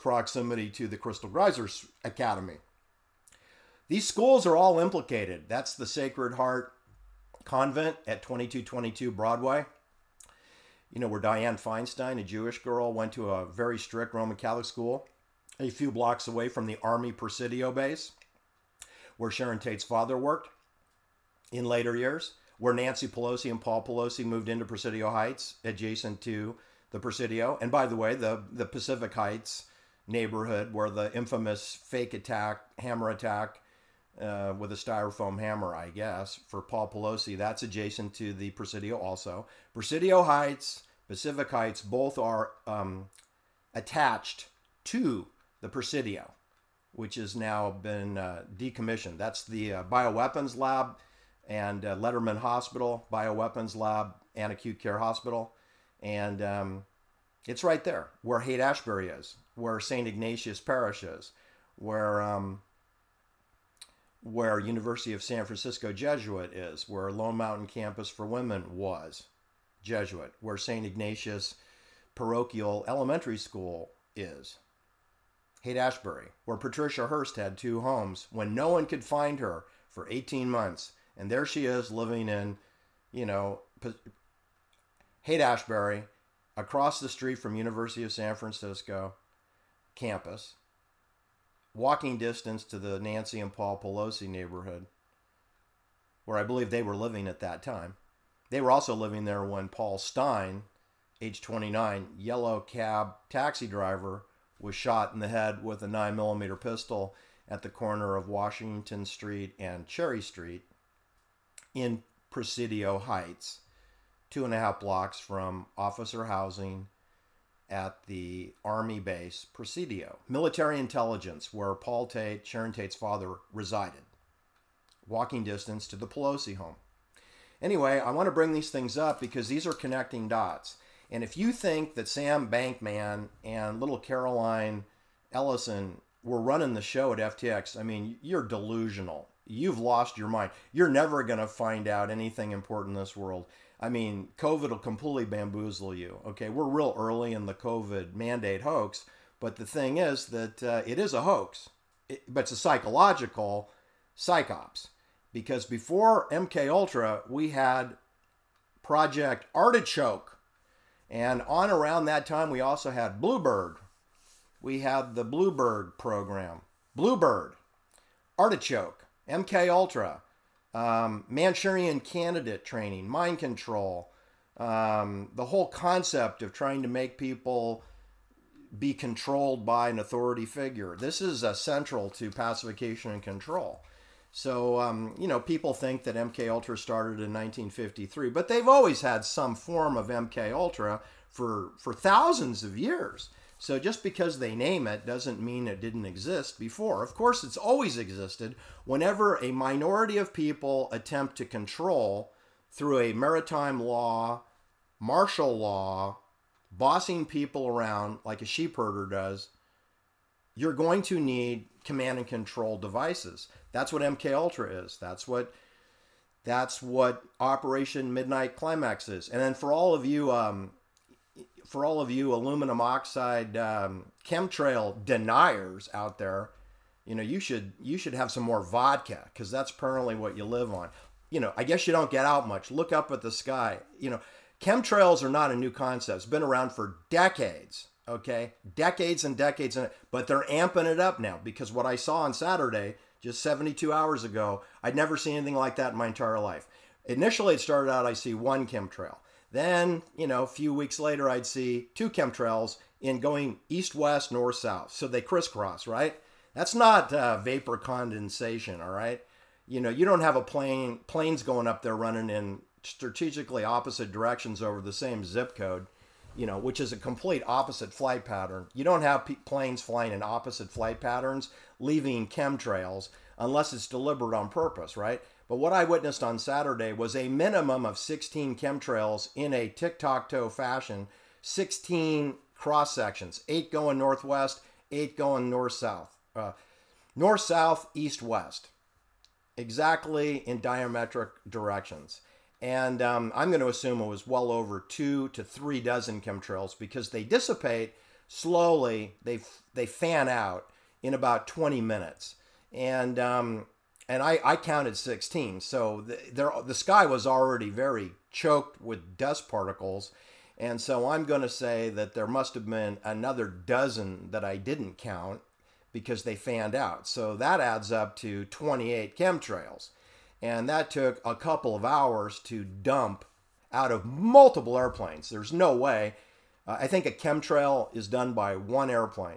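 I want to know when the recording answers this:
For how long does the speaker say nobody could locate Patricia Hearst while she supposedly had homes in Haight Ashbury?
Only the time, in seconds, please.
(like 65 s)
80 s.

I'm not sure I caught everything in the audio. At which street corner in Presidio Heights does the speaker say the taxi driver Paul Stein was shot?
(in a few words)
Washington Street and Cherry Street.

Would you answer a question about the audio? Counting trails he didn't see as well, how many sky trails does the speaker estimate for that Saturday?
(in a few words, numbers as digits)
28.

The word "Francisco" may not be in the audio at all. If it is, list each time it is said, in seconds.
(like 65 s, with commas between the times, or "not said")
65 s, 88 s.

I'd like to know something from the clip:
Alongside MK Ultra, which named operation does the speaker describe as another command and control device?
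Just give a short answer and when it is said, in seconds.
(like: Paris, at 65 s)
Operation Midnight Climax, at 217 s.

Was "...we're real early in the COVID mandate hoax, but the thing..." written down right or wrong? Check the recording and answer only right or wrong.
right.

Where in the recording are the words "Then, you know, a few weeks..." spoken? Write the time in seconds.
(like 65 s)
249 s.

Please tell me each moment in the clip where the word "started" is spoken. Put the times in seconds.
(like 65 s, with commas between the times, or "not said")
186 s, 247 s.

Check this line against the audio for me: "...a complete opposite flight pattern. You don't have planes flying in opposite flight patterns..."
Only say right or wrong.
right.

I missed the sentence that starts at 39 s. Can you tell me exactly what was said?
Presidio Heights, Pacific Heights, both are um, attached to the Presidio which has now been uh, decommissioned.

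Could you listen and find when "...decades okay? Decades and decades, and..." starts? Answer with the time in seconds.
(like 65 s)
237 s.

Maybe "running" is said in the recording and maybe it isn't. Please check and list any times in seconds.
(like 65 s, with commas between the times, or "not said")
136 s, 261 s.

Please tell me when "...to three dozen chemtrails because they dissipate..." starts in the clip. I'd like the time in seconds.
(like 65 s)
295 s.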